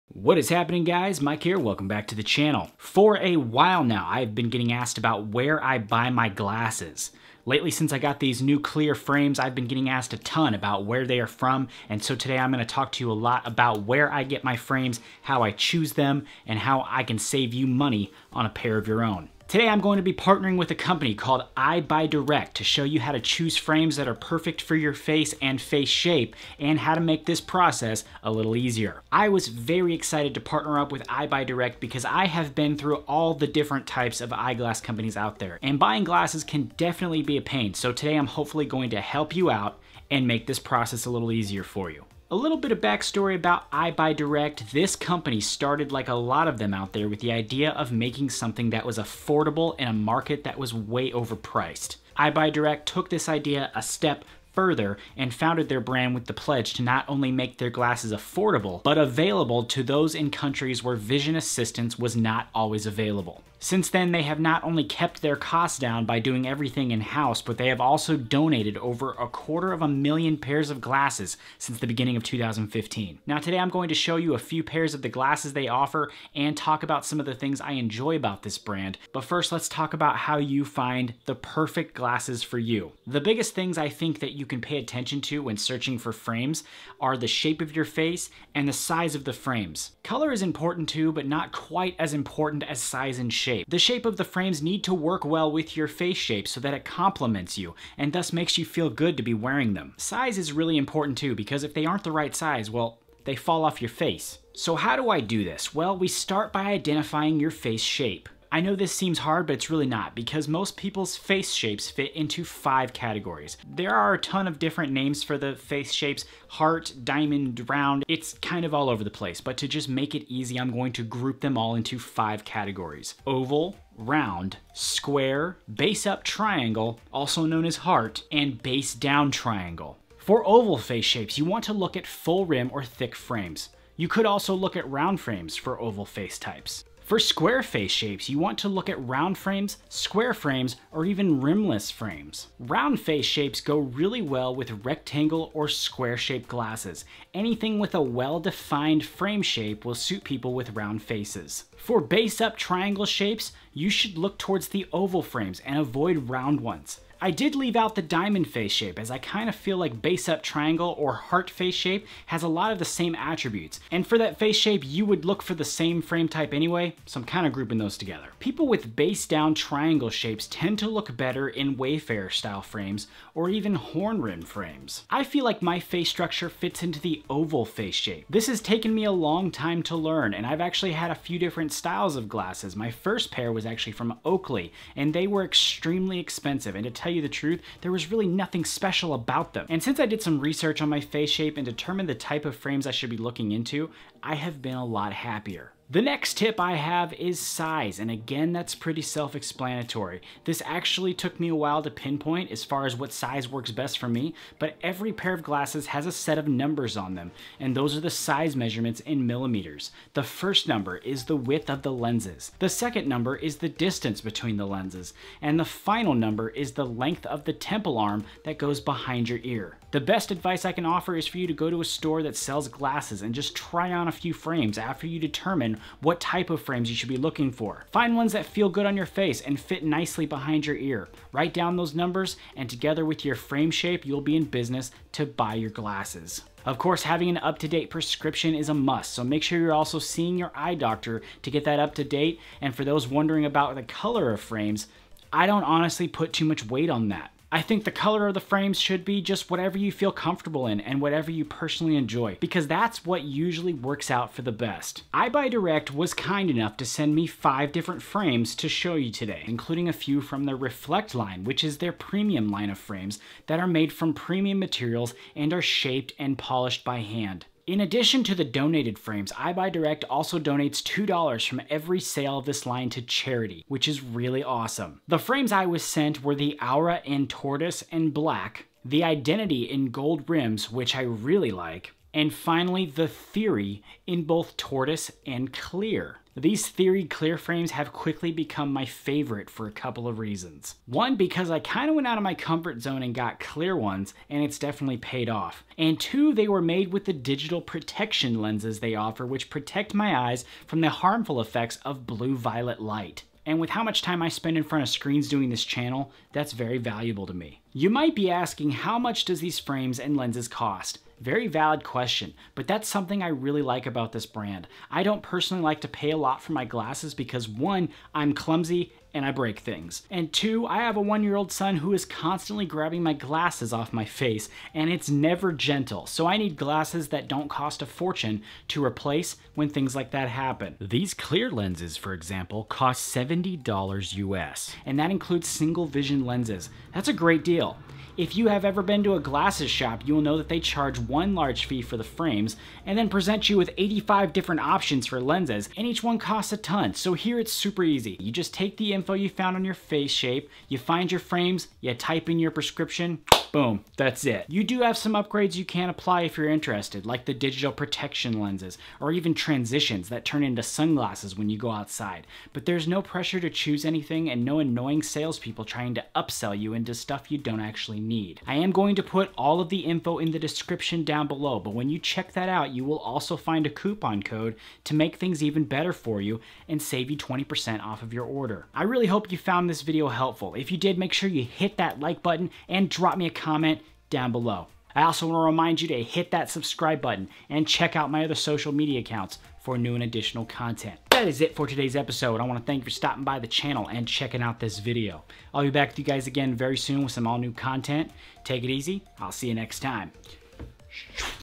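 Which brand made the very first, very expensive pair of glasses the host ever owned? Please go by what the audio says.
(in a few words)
Oakley.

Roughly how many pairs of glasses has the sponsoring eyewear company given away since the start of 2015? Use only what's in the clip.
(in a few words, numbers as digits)
Over a quarter of a million.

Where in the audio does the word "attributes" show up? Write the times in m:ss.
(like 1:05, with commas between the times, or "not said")
2:43.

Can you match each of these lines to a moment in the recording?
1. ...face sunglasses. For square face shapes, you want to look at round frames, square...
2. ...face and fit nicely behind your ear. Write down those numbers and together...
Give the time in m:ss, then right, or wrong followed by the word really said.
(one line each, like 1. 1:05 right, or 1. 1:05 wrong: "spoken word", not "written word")
1. 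2:16 wrong: "types", not "sunglasses"
2. 3:49 right.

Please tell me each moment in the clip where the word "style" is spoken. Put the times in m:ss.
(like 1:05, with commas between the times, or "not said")
2:52, 3:01.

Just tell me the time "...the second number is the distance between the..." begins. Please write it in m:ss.
3:32.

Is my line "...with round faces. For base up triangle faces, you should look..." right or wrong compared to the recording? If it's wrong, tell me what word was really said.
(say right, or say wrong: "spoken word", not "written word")
wrong: "shapes", not "faces".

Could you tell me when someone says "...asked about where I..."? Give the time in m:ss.
0:04.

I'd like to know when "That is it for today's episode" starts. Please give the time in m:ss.
6:31.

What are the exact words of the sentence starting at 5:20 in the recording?
And two, I have a one year old son who is constantly grabbing my glasses off my face and it's never gentle.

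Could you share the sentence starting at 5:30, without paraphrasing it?
These clear lenses, for example, cost $70 US and that includes single vision lenses.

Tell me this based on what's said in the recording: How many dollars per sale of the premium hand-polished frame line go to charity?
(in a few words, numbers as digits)
$2.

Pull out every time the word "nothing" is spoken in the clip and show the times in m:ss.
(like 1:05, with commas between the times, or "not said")
3:08.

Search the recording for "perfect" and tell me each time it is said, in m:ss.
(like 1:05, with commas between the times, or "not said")
0:24, 1:21.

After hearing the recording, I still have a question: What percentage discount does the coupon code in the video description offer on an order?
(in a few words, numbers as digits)
20%.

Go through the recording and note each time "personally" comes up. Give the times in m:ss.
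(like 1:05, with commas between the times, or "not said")
4:11, 5:15.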